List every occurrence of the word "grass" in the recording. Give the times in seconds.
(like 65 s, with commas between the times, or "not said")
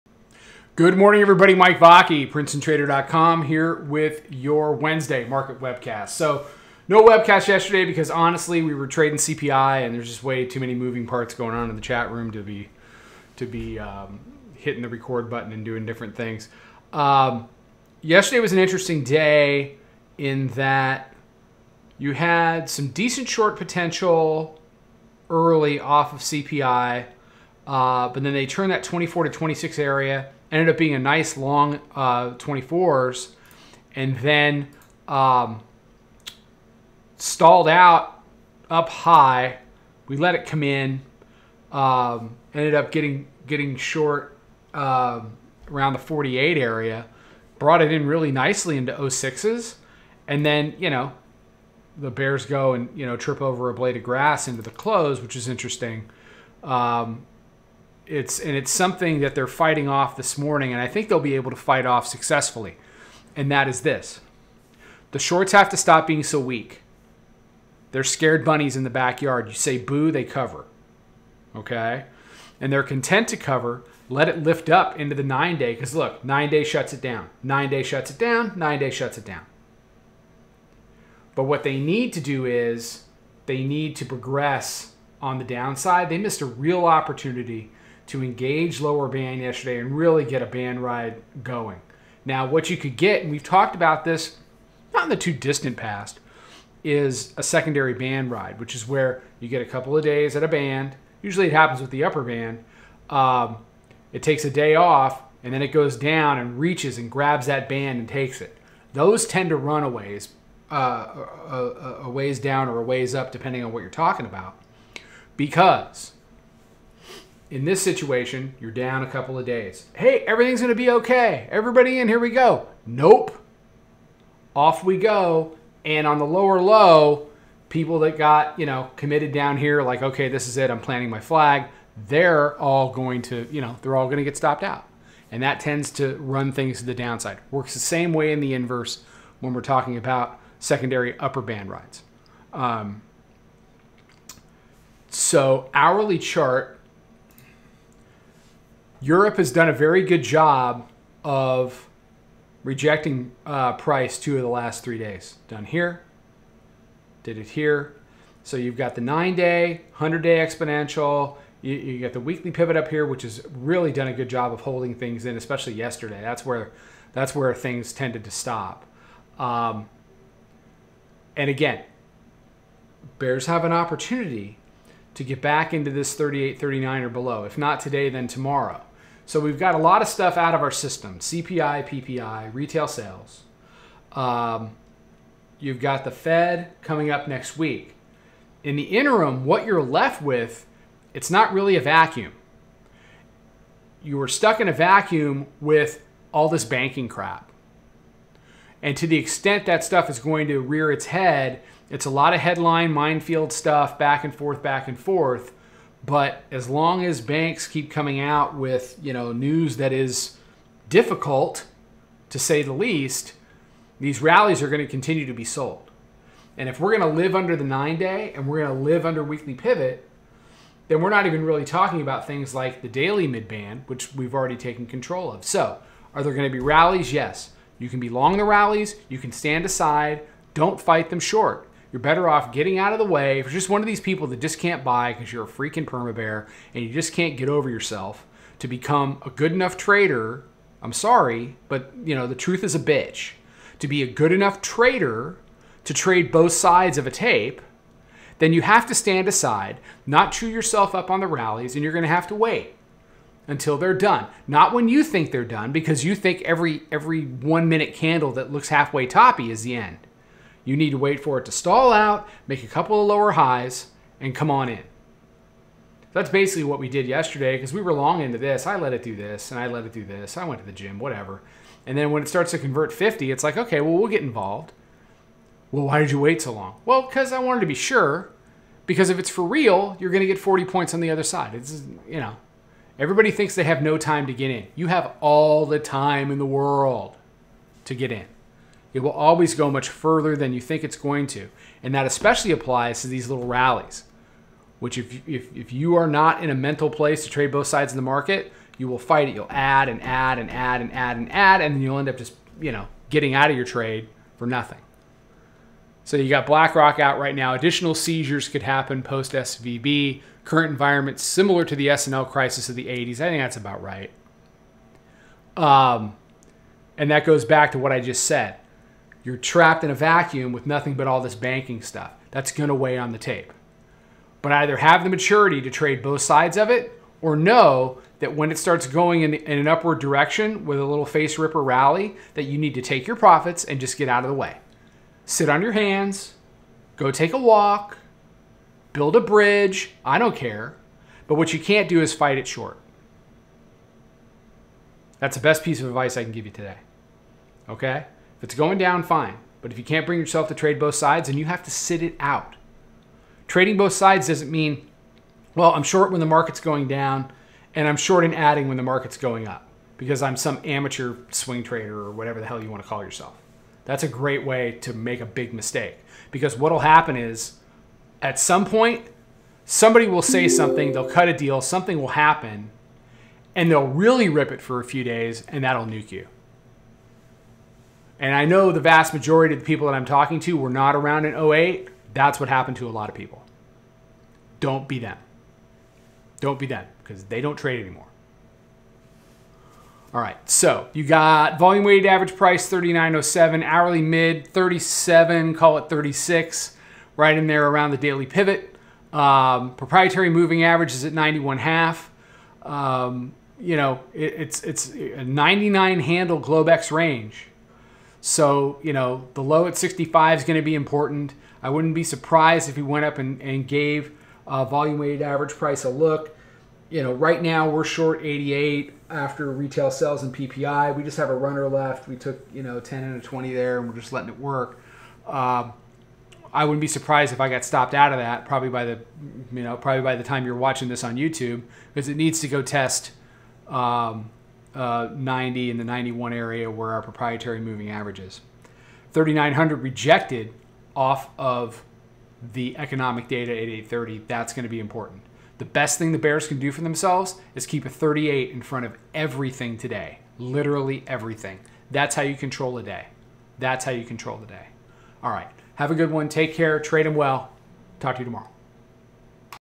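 54 s.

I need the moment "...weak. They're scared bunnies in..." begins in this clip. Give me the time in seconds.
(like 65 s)
66 s.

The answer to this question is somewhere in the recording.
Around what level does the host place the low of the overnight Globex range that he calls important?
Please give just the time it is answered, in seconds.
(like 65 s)
409 s.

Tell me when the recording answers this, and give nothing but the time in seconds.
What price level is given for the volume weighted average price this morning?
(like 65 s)
392 s.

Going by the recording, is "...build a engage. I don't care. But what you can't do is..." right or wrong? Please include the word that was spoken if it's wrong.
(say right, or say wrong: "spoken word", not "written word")
wrong: "bridge", not "engage".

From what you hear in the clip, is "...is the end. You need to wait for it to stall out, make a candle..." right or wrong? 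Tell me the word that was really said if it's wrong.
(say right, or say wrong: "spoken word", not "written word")
wrong: "couple", not "candle".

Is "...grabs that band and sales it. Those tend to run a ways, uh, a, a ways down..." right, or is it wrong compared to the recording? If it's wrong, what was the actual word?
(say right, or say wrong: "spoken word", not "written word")
wrong: "takes", not "sales".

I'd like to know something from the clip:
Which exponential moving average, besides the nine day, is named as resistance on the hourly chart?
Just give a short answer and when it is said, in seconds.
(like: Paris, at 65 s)
100 day, at 159 s.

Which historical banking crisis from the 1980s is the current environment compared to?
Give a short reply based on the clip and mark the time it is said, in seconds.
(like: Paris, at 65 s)
S&L crisis, at 311 s.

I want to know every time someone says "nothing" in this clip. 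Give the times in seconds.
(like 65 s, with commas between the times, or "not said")
304 s, 320 s.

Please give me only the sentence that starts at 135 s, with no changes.
And that tends to run things to the downside.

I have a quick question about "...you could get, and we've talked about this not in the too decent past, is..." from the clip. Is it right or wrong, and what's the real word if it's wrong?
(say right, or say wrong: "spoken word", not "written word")
wrong: "distant", not "decent".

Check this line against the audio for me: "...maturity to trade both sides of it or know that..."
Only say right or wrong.
right.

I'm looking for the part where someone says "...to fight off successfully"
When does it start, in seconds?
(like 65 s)
61 s.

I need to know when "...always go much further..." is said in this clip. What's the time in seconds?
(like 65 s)
289 s.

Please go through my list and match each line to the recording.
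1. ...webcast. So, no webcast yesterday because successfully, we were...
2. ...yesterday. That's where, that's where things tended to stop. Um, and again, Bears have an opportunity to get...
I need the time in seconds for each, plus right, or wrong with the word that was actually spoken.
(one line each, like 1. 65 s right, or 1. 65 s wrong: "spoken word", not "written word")
1. 5 s wrong: "honestly", not "successfully"
2. 165 s right.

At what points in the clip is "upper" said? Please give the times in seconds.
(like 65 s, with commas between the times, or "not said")
102 s, 141 s.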